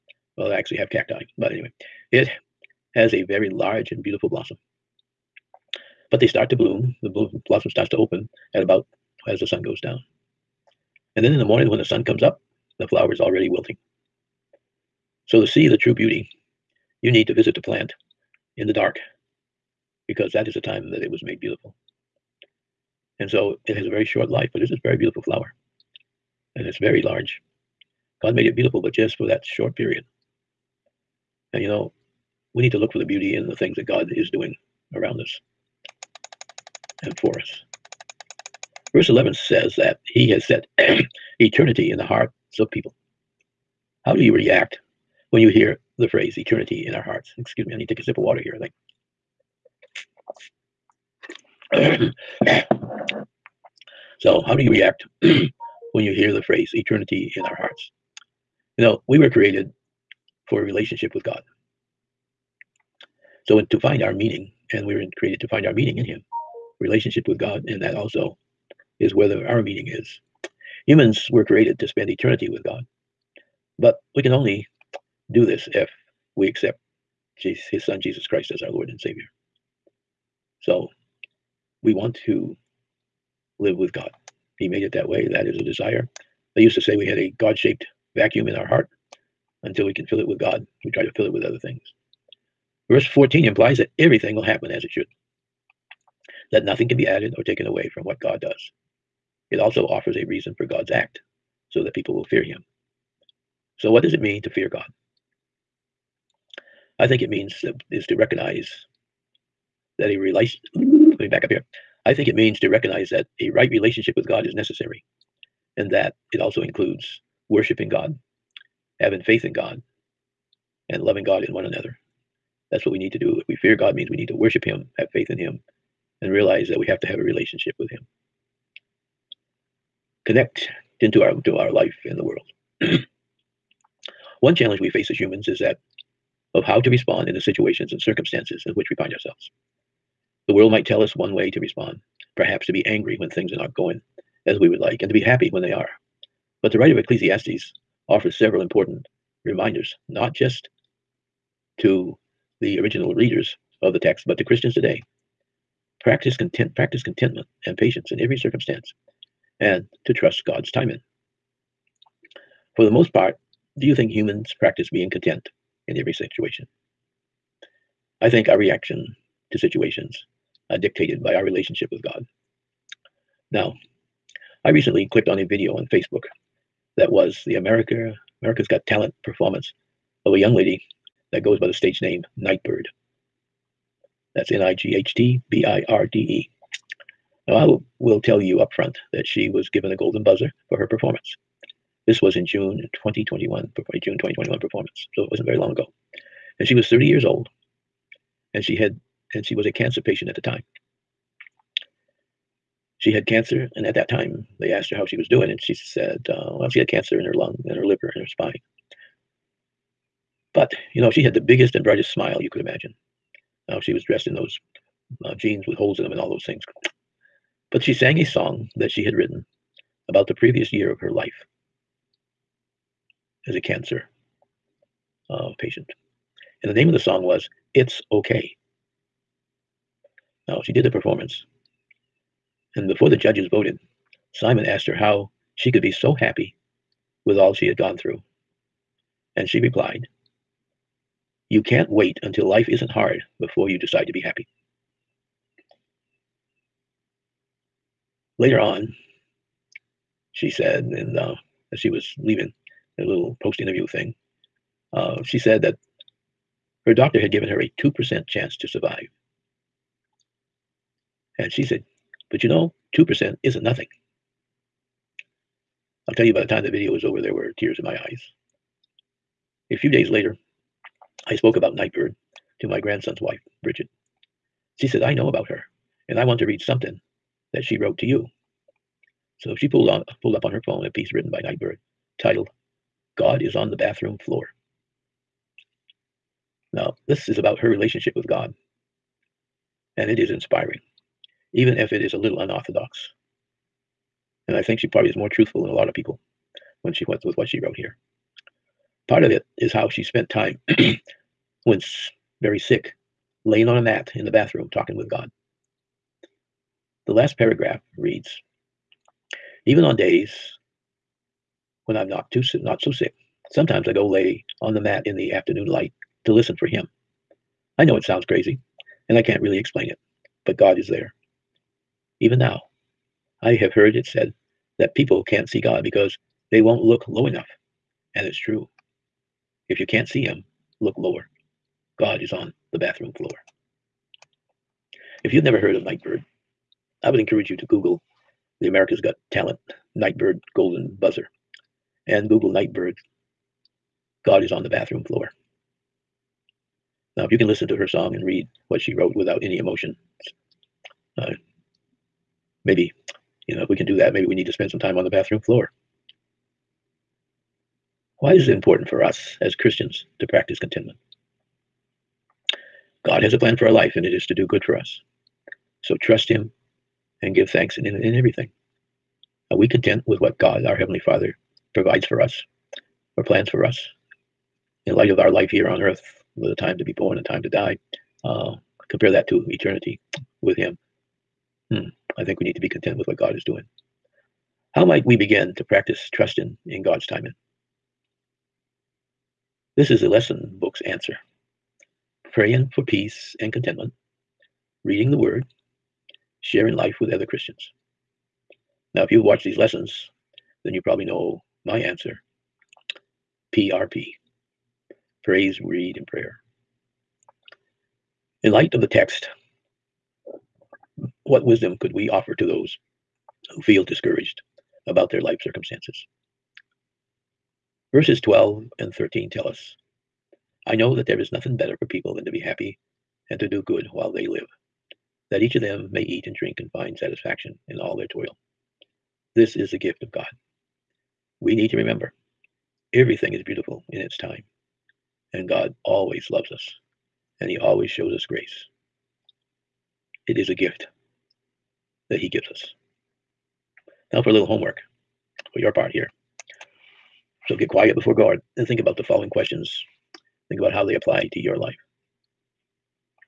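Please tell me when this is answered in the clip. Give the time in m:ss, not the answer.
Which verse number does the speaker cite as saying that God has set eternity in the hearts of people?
0:38.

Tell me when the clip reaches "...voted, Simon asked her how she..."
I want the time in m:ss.
3:53.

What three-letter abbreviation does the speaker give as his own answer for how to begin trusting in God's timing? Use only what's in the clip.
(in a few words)
PRP.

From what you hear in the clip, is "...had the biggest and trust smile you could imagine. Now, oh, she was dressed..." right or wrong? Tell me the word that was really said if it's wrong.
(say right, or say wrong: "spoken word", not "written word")
wrong: "brightest", not "trust".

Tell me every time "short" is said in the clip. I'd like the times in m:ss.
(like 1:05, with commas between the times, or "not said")
0:24, 0:29.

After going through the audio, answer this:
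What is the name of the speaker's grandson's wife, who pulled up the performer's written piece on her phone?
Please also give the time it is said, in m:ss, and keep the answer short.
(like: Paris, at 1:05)
Bridget, at 4:33.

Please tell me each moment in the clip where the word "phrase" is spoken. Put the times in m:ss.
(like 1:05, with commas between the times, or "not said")
0:46, 0:56.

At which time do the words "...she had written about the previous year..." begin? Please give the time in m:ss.
3:38.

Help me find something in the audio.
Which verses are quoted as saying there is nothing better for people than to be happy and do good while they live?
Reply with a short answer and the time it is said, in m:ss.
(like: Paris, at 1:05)
Verses 12 and 13, at 6:57.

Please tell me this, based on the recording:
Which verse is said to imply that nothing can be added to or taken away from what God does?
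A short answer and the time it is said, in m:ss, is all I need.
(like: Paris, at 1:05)
Verse 14, at 1:32.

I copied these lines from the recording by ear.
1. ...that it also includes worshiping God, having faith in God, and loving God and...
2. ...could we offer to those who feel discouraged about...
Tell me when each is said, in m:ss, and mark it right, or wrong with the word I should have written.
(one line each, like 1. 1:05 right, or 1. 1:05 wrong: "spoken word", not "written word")
1. 1:55 right
2. 6:51 right.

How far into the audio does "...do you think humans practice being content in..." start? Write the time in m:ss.
2:43.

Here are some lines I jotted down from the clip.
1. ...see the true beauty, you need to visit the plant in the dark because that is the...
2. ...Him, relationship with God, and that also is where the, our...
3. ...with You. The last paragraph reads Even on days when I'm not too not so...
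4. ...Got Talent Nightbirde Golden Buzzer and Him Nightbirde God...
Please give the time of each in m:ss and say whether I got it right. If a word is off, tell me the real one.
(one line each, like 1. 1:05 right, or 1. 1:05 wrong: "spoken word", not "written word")
1. 0:15 right
2. 1:06 right
3. 5:04 wrong: "God", not "You"
4. 5:39 wrong: "Google", not "Him".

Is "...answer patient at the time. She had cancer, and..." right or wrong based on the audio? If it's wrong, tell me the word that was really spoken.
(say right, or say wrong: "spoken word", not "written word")
wrong: "cancer", not "answer".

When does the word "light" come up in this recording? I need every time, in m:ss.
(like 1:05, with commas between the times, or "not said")
5:15, 6:14, 6:48.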